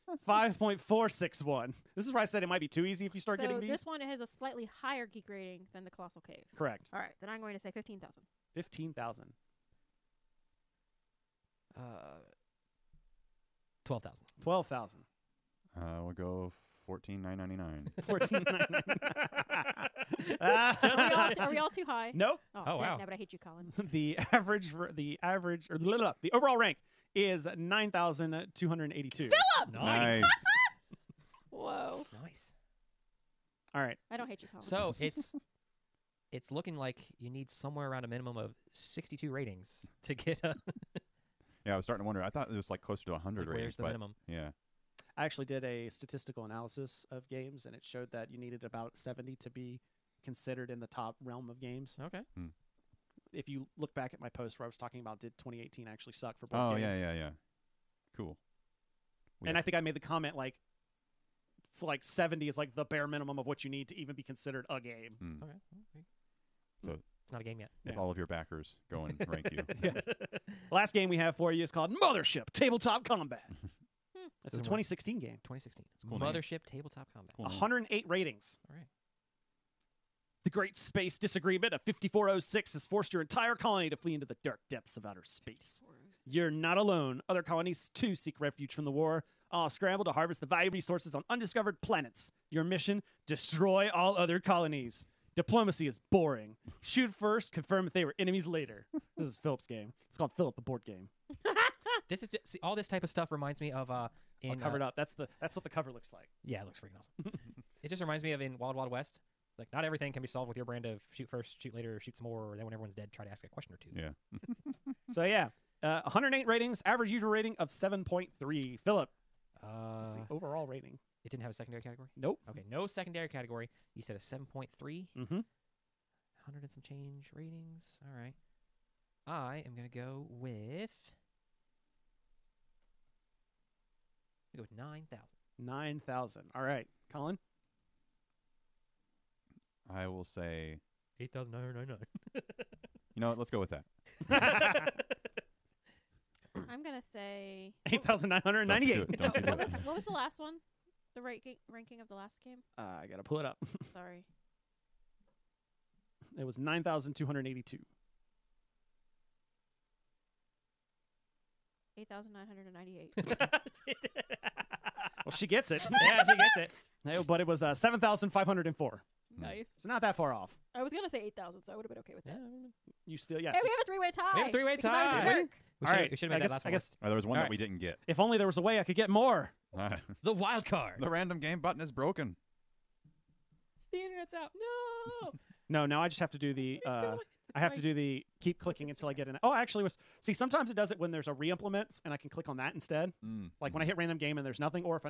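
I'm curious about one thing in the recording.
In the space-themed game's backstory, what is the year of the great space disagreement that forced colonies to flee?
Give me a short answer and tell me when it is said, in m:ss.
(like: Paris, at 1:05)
5406, at 1:21.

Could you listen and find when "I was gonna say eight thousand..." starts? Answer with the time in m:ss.
2:50.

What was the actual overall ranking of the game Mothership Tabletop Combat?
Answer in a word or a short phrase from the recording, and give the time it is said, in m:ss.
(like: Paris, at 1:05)
7,504, at 2:47.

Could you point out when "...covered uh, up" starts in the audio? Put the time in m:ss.
1:44.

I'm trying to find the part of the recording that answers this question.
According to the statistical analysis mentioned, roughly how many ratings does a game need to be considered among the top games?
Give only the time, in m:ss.
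0:48.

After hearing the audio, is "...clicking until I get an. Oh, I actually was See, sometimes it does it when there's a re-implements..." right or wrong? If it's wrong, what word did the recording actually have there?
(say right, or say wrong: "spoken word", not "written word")
right.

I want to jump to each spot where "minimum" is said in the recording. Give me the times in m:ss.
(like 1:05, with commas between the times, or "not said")
0:38, 0:43, 1:03.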